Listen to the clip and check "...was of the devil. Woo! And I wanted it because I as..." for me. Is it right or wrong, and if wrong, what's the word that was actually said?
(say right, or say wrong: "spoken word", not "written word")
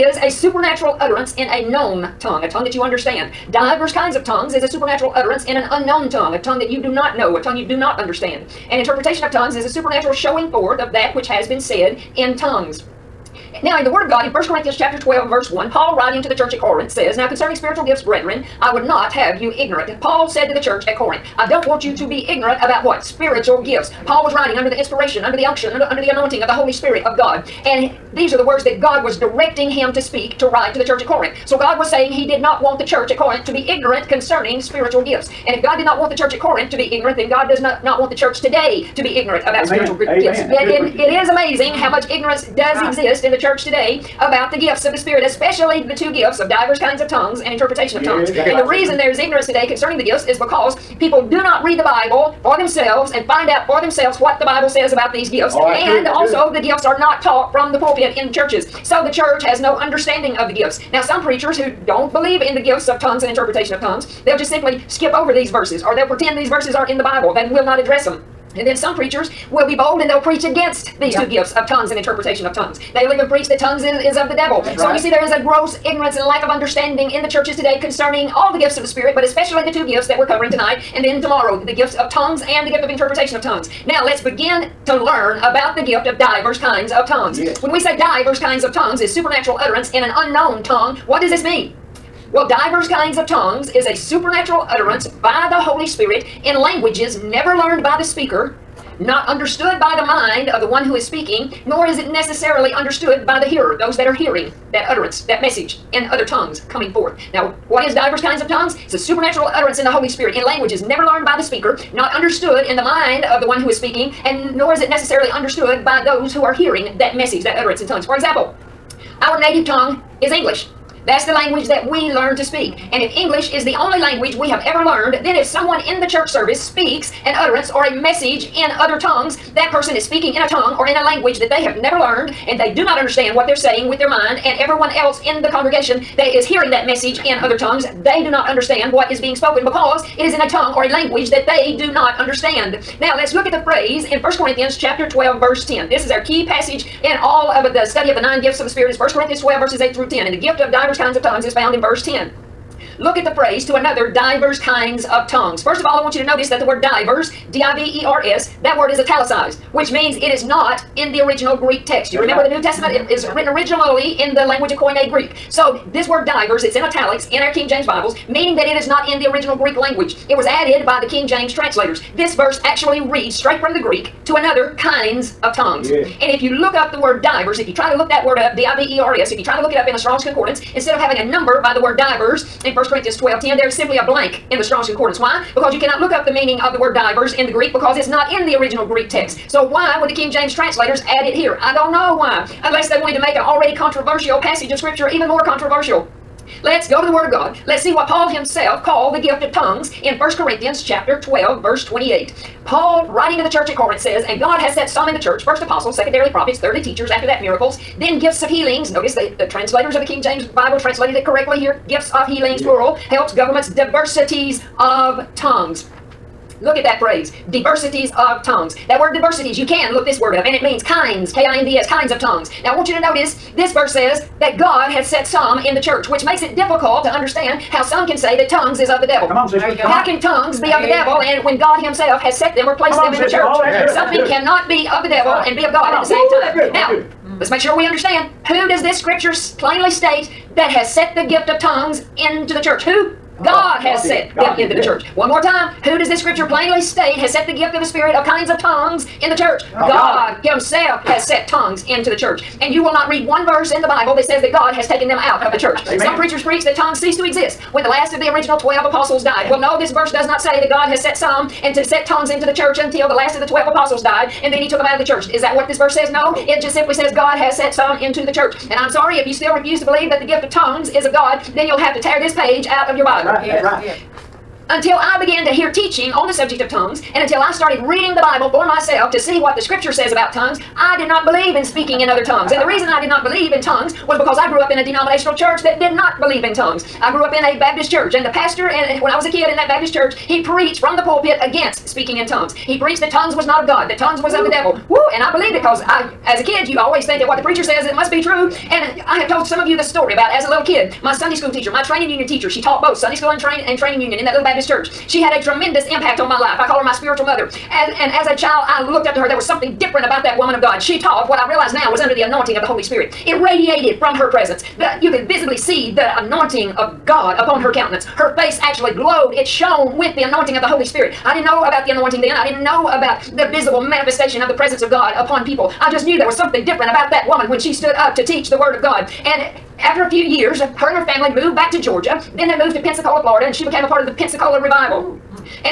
wrong: "believed", not "wanted".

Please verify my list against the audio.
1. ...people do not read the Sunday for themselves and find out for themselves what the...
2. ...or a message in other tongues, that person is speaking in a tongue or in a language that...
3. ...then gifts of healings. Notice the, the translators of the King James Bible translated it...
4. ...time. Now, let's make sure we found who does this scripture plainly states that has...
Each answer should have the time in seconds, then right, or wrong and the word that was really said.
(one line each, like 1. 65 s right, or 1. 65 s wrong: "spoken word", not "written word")
1. 50 s wrong: "Bible", not "Sunday"
2. 127 s right
3. 207 s right
4. 236 s wrong: "understand", not "found".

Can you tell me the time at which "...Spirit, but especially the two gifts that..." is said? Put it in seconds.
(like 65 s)
78 s.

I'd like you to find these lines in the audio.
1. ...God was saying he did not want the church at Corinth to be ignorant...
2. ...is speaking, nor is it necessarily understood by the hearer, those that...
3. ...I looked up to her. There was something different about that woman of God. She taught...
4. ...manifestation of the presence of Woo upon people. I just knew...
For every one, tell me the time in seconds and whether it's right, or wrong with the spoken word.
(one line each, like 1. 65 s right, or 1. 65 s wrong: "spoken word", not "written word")
1. 31 s right
2. 100 s right
3. 308 s right
4. 323 s wrong: "God", not "Woo".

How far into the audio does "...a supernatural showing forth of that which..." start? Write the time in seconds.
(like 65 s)
9 s.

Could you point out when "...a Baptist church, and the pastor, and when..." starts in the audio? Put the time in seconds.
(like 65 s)
287 s.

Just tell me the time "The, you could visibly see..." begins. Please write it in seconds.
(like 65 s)
314 s.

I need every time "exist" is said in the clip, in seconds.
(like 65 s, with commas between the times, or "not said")
42 s, 257 s.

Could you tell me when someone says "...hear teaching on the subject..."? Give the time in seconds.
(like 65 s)
275 s.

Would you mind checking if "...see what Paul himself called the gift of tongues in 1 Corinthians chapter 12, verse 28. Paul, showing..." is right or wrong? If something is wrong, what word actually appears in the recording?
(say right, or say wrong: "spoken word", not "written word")
wrong: "writing", not "showing".